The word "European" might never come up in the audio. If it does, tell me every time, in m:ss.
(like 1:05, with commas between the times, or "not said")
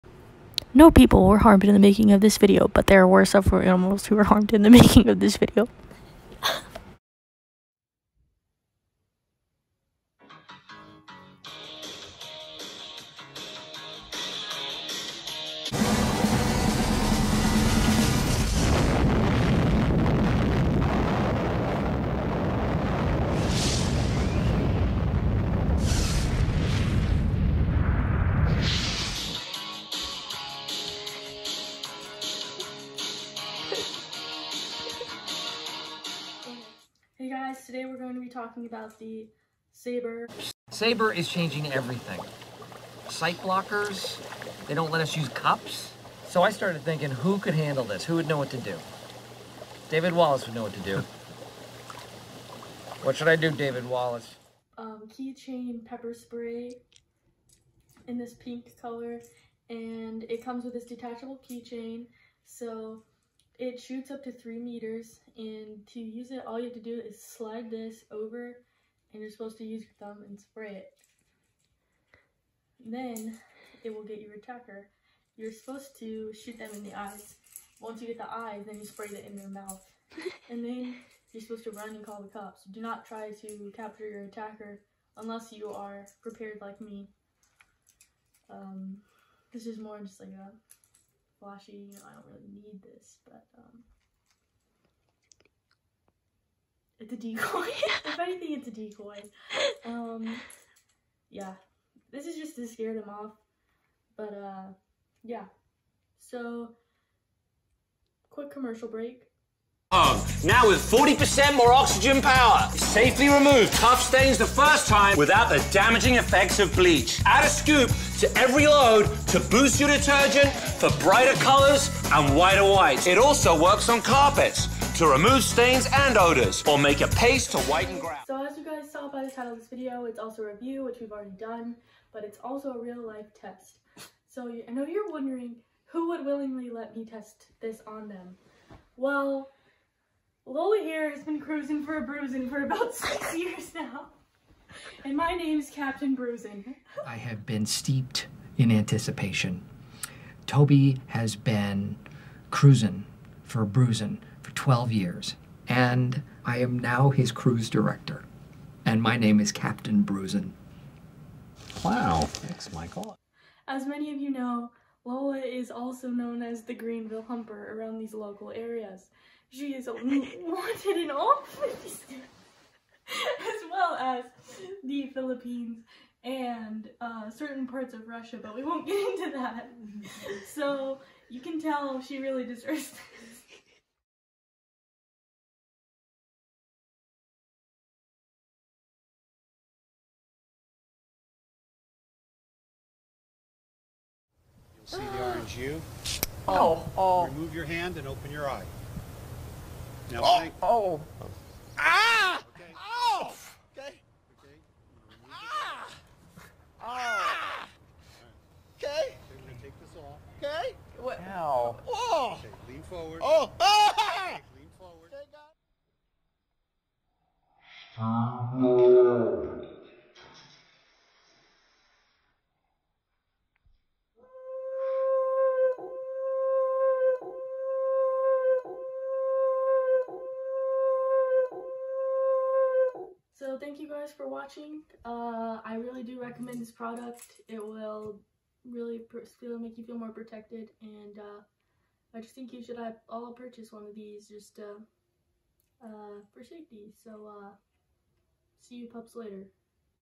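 not said.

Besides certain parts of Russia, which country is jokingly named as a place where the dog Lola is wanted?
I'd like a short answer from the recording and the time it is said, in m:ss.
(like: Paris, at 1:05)
the Philippines, at 2:55.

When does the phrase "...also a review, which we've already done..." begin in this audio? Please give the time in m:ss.
2:10.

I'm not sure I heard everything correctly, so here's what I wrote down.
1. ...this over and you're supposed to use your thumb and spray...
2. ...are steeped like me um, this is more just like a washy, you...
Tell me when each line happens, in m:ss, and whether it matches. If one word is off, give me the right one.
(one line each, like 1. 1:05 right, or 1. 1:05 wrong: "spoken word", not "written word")
1. 1:07 right
2. 1:25 wrong: "prepared", not "steeped".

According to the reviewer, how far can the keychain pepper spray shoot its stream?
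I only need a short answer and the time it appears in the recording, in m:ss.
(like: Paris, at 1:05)
3 meters, at 1:04.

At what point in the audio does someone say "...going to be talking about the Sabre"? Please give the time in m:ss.
0:37.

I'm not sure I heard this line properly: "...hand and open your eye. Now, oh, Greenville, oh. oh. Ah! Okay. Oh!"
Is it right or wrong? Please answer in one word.
wrong.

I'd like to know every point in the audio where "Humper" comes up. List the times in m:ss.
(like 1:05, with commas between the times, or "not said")
2:47.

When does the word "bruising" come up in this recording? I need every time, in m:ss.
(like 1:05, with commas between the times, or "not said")
2:22, 2:26, 2:33, 2:40.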